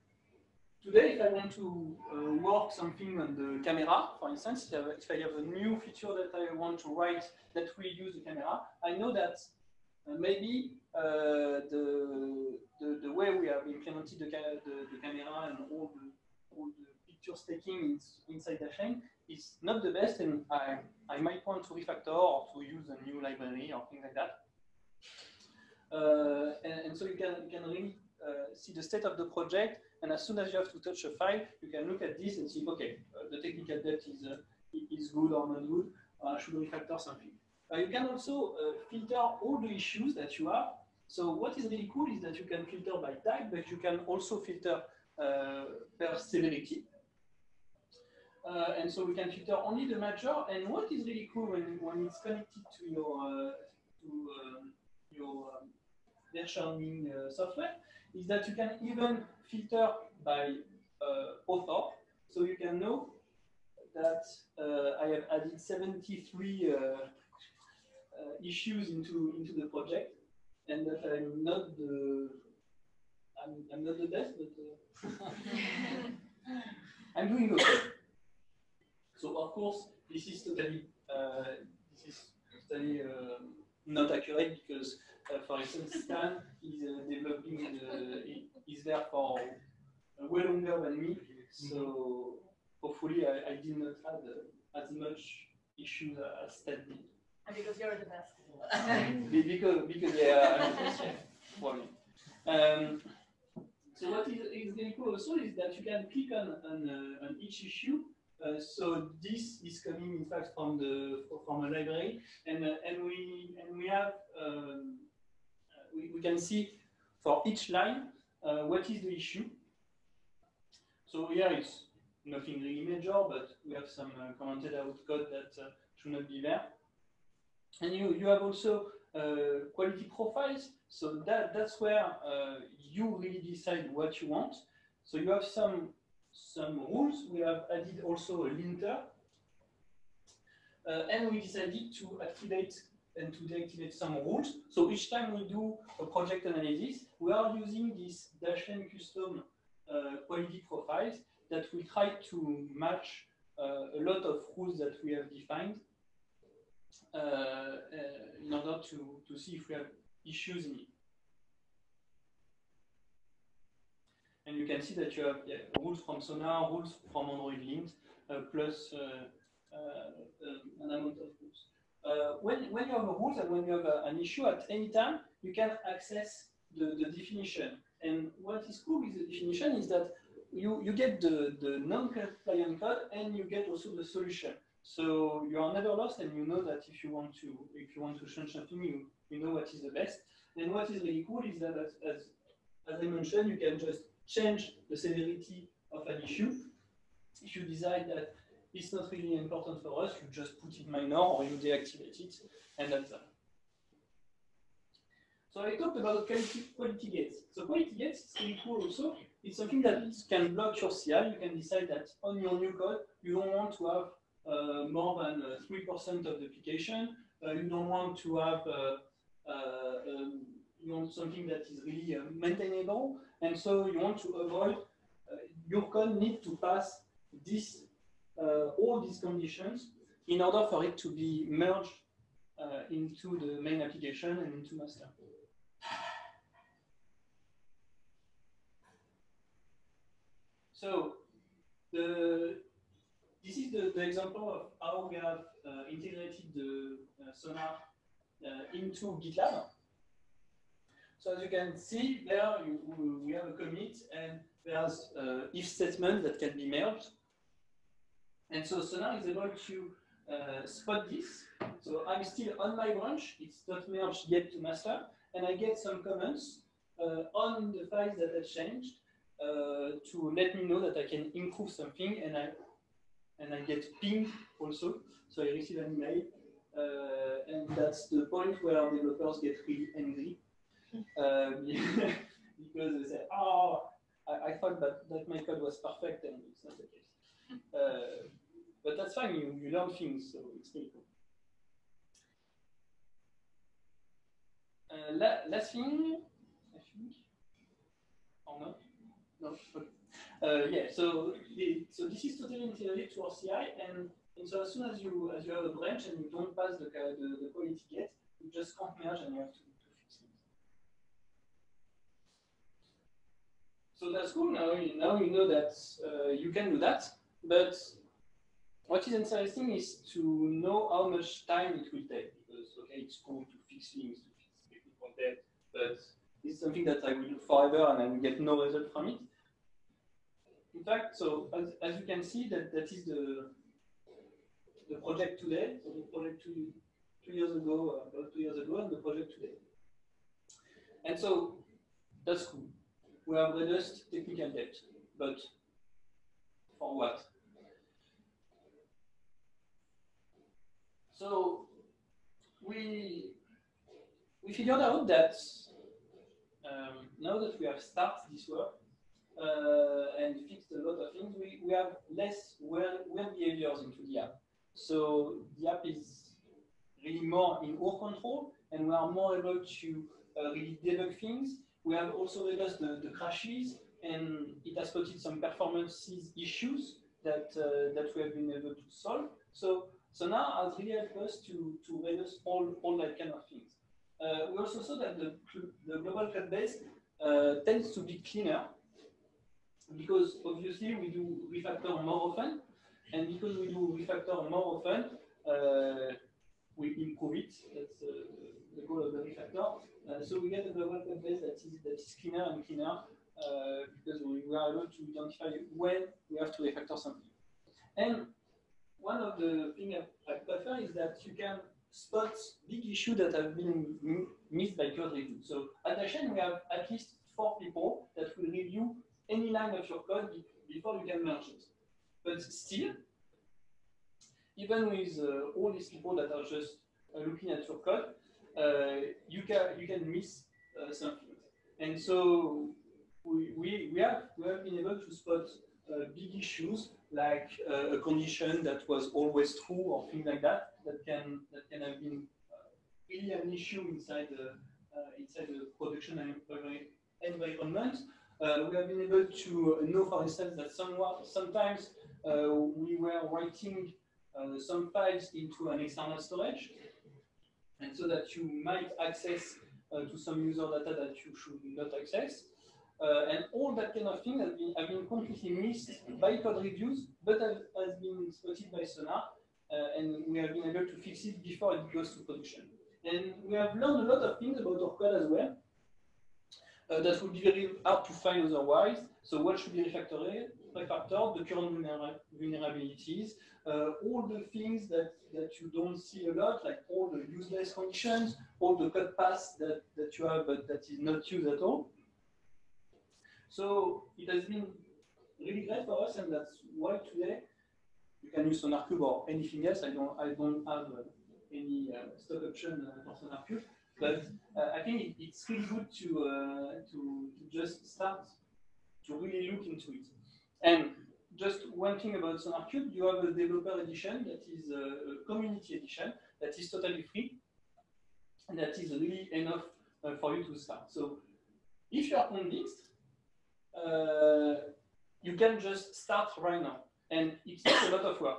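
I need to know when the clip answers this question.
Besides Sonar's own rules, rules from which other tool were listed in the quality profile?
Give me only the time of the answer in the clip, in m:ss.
2:47.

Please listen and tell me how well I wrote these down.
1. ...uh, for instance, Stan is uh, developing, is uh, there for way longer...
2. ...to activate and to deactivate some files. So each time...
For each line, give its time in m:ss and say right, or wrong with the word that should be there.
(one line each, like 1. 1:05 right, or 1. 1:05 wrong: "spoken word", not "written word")
1. 1:25 right
2. 2:21 wrong: "rules", not "files".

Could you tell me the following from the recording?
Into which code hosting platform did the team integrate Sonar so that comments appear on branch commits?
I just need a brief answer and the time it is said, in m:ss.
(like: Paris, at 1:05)
GitLab, at 4:09.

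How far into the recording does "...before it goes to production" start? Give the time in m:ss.
7:51.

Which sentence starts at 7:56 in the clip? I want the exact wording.
Uh, that would be very hard to find otherwise.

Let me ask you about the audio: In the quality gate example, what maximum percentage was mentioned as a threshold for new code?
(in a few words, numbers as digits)
3%.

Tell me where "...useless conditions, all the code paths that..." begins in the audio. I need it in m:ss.
8:07.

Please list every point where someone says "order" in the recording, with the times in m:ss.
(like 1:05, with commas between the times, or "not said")
2:38, 3:50.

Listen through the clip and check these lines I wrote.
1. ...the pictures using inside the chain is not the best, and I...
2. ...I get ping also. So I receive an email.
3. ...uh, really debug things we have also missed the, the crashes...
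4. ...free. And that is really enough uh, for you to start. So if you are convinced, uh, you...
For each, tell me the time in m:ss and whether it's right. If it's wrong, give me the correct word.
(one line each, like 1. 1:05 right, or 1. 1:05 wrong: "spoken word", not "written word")
1. 0:16 wrong: "taking", not "using"
2. 4:33 right
3. 6:10 wrong: "reduced", not "missed"
4. 8:37 right.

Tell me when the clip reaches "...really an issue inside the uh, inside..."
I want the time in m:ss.
7:23.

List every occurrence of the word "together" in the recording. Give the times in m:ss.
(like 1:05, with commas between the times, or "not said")
not said.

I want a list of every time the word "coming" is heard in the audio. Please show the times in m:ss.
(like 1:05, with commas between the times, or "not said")
1:49.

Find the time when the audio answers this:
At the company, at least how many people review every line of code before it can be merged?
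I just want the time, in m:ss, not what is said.
6:57.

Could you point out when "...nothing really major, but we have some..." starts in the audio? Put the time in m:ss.
2:02.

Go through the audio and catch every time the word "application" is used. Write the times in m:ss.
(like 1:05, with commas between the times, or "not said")
3:36, 3:53.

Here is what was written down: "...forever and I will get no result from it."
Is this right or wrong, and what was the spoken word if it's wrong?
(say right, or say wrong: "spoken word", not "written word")
right.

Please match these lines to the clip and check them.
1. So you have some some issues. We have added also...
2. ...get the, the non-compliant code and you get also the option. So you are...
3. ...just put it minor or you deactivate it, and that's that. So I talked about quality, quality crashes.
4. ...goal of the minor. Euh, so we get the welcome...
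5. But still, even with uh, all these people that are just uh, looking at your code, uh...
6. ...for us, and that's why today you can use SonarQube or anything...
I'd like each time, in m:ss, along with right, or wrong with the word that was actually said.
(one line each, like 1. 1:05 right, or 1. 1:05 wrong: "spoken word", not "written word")
1. 2:15 wrong: "rules", not "issues"
2. 3:00 wrong: "solution", not "option"
3. 3:20 wrong: "gates", not "crashes"
4. 6:38 wrong: "refactor", not "minor"
5. 7:02 right
6. 8:15 right.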